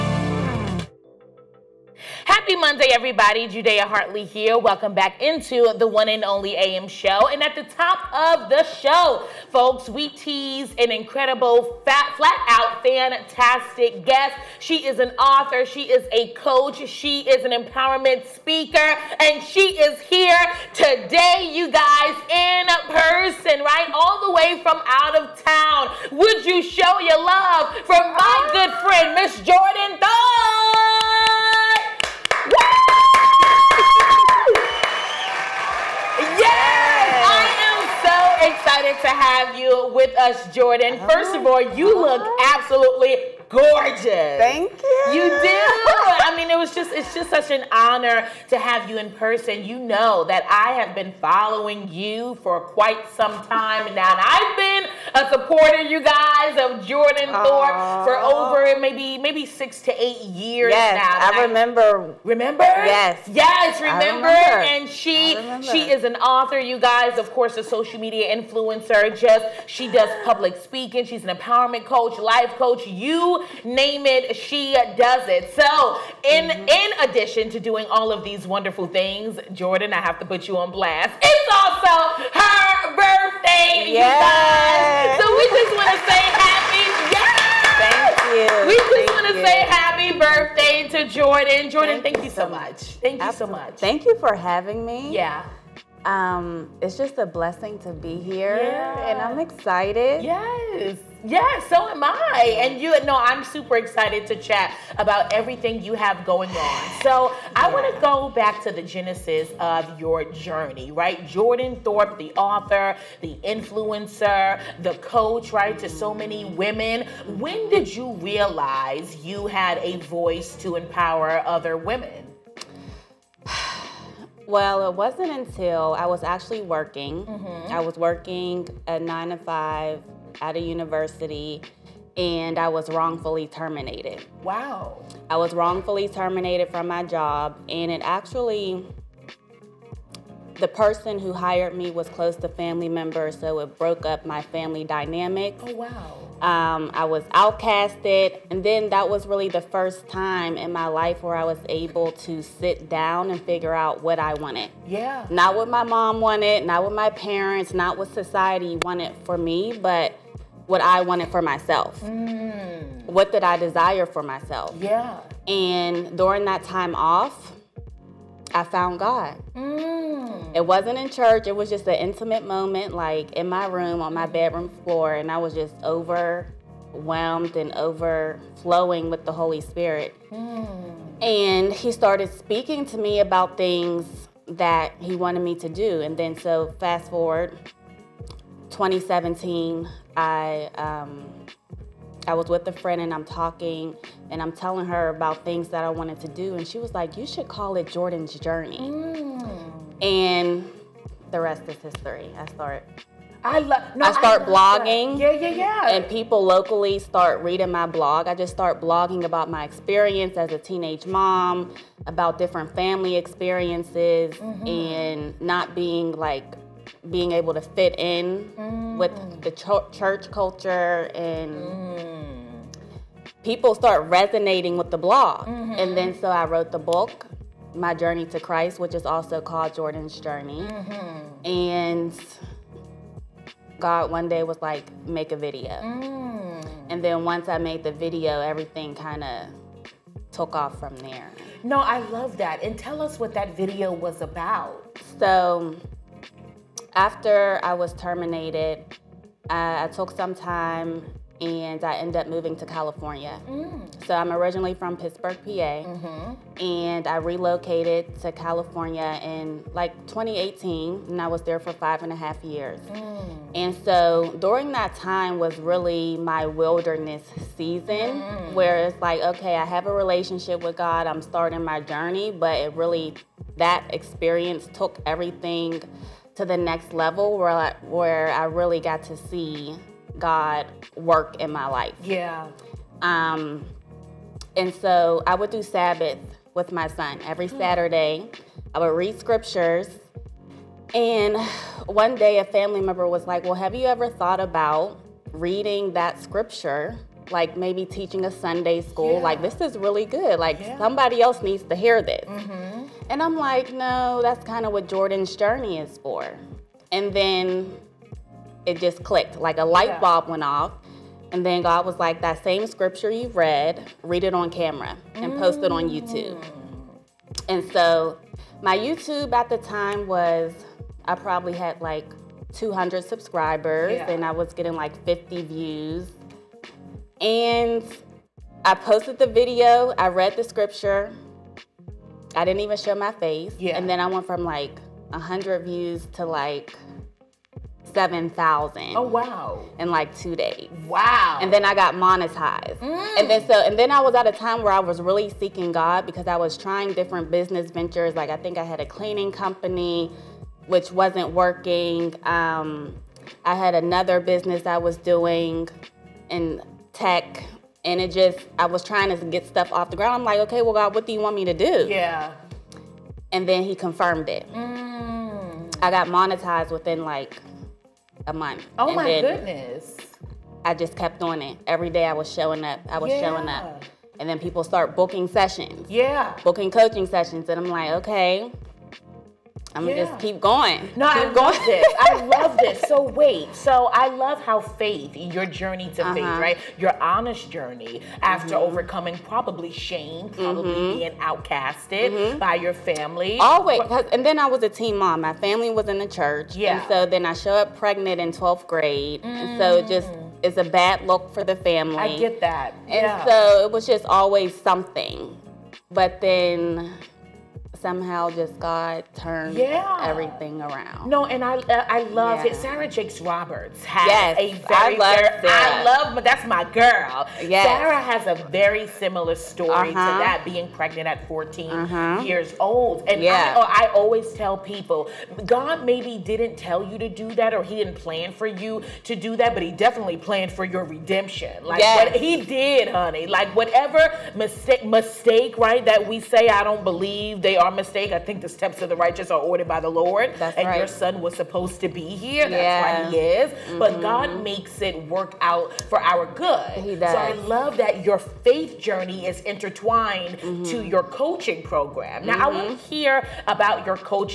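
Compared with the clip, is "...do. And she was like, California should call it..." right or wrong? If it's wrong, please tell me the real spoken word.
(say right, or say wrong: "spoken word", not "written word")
wrong: "You", not "California".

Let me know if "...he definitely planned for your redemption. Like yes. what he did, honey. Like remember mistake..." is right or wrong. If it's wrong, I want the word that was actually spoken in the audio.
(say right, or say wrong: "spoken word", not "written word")
wrong: "whatever", not "remember".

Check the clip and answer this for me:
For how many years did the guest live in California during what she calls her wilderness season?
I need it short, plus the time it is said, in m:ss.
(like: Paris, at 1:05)
5.5, at 4:21.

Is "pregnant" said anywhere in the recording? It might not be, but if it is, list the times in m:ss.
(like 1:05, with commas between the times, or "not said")
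6:37, 7:00.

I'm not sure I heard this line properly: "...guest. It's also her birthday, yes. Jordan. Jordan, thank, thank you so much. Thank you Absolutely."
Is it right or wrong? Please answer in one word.
wrong.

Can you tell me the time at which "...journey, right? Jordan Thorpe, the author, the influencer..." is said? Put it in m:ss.
1:50.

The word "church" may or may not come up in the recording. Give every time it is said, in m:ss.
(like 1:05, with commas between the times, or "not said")
2:51, 3:39, 6:36.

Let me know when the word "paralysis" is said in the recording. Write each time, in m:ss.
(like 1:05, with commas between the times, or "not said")
not said.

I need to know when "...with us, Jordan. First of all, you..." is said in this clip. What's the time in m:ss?
0:39.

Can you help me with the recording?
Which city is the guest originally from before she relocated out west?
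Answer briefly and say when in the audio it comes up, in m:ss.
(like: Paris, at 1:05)
Pittsburgh, at 4:15.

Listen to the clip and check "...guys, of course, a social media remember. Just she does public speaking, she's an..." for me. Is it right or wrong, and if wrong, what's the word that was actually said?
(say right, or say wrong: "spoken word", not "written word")
wrong: "influencer", not "remember".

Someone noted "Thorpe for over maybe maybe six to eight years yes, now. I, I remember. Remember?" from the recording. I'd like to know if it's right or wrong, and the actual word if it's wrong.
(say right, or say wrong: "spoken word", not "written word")
right.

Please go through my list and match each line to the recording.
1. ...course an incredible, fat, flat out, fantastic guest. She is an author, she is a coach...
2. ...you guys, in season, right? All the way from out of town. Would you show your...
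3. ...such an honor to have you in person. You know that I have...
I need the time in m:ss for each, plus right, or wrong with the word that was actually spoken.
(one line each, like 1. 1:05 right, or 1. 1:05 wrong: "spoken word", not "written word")
1. 0:10 wrong: "tease", not "course"
2. 0:21 wrong: "person", not "season"
3. 0:47 right.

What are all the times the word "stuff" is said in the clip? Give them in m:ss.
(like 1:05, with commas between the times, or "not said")
5:59.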